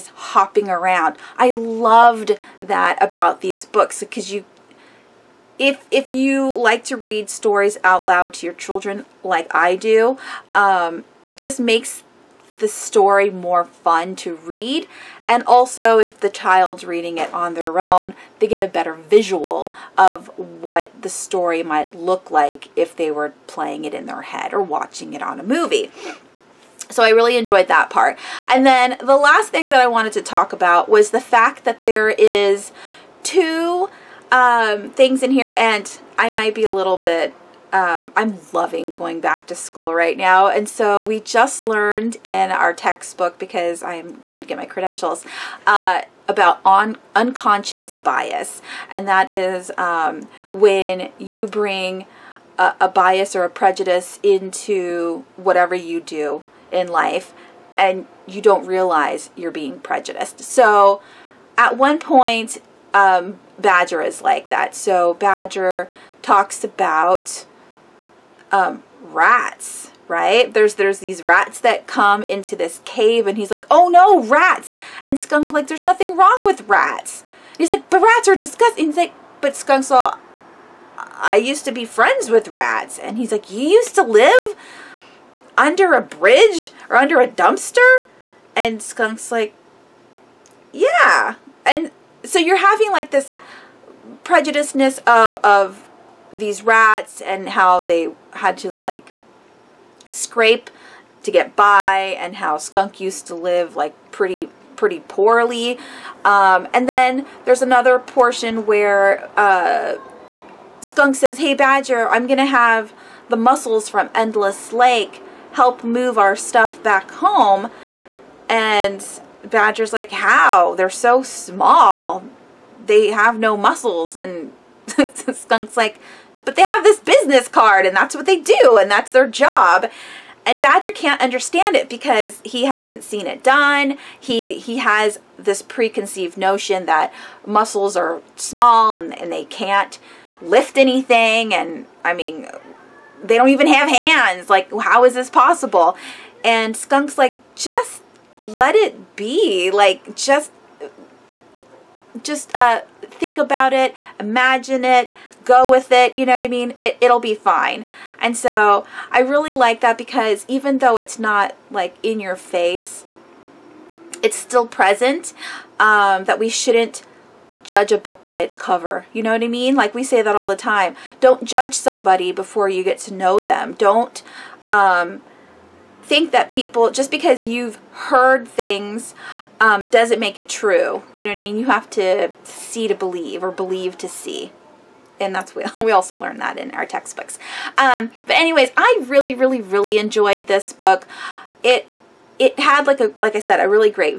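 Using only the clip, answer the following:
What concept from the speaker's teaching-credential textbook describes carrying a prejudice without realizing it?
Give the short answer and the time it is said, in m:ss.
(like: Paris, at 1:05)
unconscious bias, at 0:47.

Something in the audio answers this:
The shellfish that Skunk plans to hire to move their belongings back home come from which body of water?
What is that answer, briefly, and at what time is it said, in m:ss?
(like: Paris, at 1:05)
Endless Lake, at 1:54.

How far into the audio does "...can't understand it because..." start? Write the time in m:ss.
2:10.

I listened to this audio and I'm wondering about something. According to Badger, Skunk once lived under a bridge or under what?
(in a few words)
a dumpster.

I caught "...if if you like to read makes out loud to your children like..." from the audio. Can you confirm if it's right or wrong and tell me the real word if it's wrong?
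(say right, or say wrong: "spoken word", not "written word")
wrong: "stories", not "makes".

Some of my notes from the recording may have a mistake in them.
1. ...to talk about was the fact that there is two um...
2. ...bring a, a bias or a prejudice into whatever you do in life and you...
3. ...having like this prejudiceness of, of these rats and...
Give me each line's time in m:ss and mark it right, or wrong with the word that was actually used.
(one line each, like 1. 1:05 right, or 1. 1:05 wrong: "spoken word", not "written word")
1. 0:30 right
2. 0:51 right
3. 1:32 right.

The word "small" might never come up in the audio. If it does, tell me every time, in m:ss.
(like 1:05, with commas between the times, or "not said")
2:01, 2:18.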